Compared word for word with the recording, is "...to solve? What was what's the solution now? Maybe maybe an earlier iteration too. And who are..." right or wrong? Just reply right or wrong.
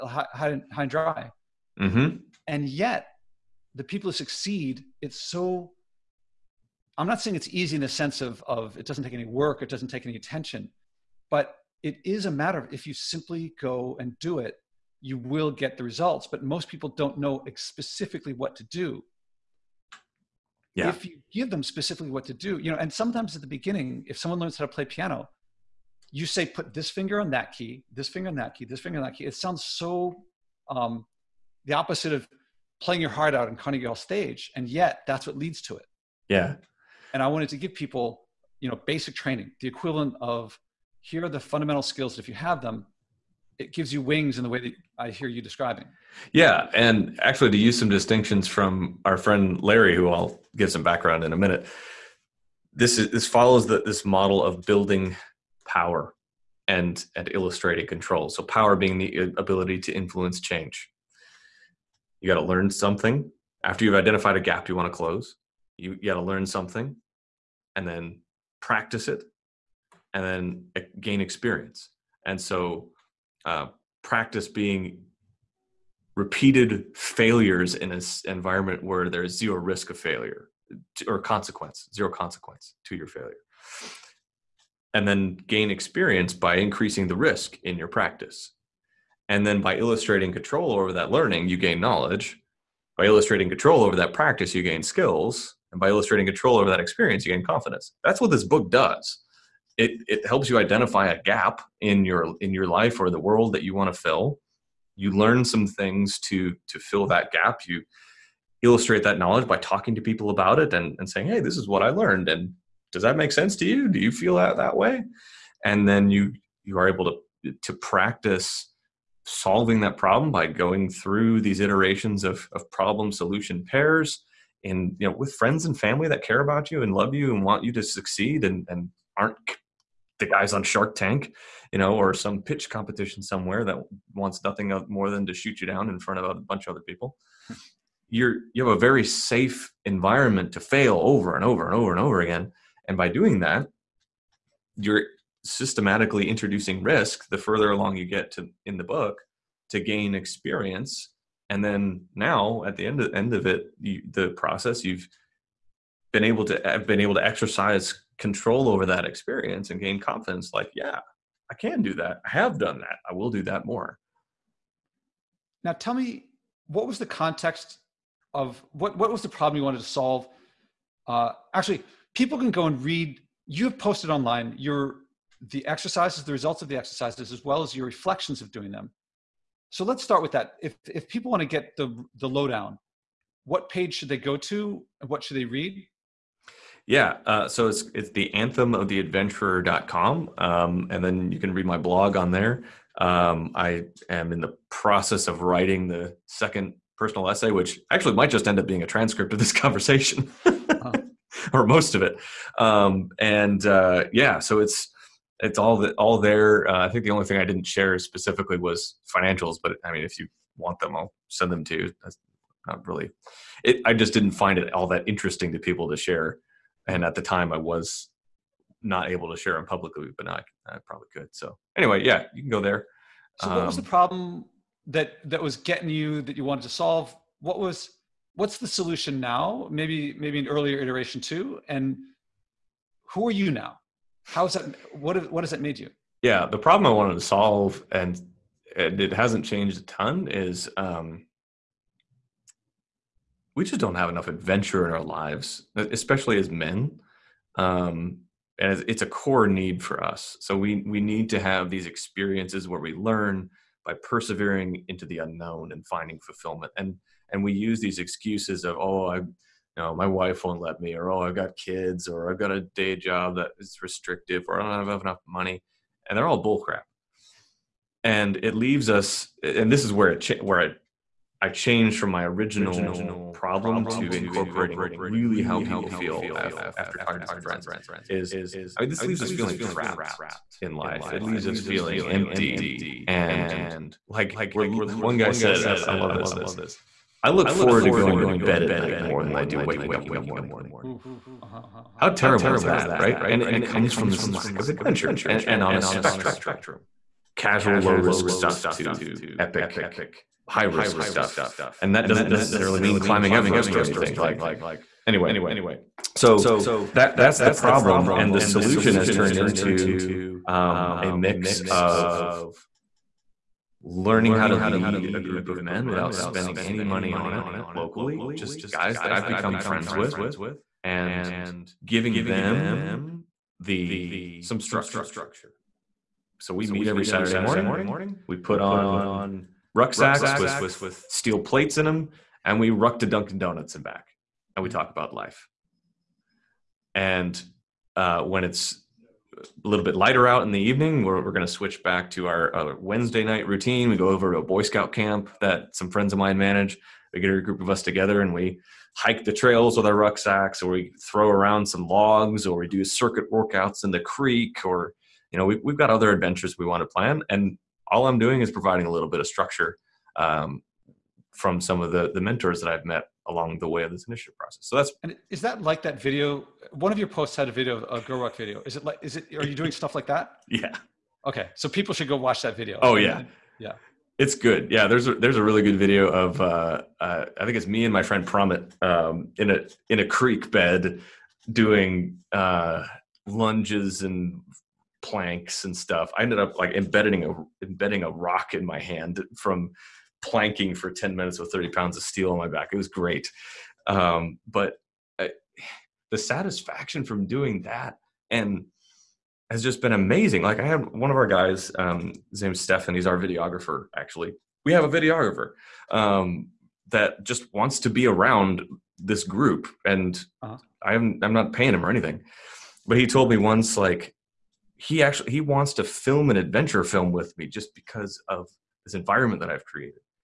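right.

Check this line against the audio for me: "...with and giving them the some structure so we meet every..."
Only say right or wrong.
right.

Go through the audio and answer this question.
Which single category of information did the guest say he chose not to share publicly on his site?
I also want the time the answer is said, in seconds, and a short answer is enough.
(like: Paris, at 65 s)
financials, at 209 s.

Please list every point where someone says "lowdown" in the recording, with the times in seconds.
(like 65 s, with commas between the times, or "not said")
182 s.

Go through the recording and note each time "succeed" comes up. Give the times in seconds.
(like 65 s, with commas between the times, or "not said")
4 s, 127 s.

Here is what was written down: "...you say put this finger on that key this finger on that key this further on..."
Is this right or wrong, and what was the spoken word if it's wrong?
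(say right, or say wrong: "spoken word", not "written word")
wrong: "finger", not "further".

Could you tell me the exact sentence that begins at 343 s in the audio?
We go over to a Boy Scout camp that some friends of mine manage.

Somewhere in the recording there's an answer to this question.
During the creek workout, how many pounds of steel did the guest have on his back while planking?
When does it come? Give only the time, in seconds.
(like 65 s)
391 s.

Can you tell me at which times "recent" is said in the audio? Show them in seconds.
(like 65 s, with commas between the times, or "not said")
not said.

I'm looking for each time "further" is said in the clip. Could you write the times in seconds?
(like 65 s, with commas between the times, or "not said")
147 s.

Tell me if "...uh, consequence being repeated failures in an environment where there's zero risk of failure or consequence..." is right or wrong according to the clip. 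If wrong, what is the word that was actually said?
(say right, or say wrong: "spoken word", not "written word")
wrong: "practice", not "consequence".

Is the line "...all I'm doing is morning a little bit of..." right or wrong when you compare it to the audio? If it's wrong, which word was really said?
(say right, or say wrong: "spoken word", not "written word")
wrong: "providing", not "morning".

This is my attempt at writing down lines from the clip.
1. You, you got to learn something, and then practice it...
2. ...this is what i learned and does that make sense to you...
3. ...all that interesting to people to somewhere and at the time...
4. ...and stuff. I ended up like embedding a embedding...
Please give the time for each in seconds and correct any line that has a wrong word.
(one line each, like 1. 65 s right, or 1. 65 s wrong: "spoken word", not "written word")
1. 65 s right
2. 111 s right
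3. 214 s wrong: "share", not "somewhere"
4. 385 s right.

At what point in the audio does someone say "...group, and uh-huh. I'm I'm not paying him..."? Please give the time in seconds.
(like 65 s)
409 s.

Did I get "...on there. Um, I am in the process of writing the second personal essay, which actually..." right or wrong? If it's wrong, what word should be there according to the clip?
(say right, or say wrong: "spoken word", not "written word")
right.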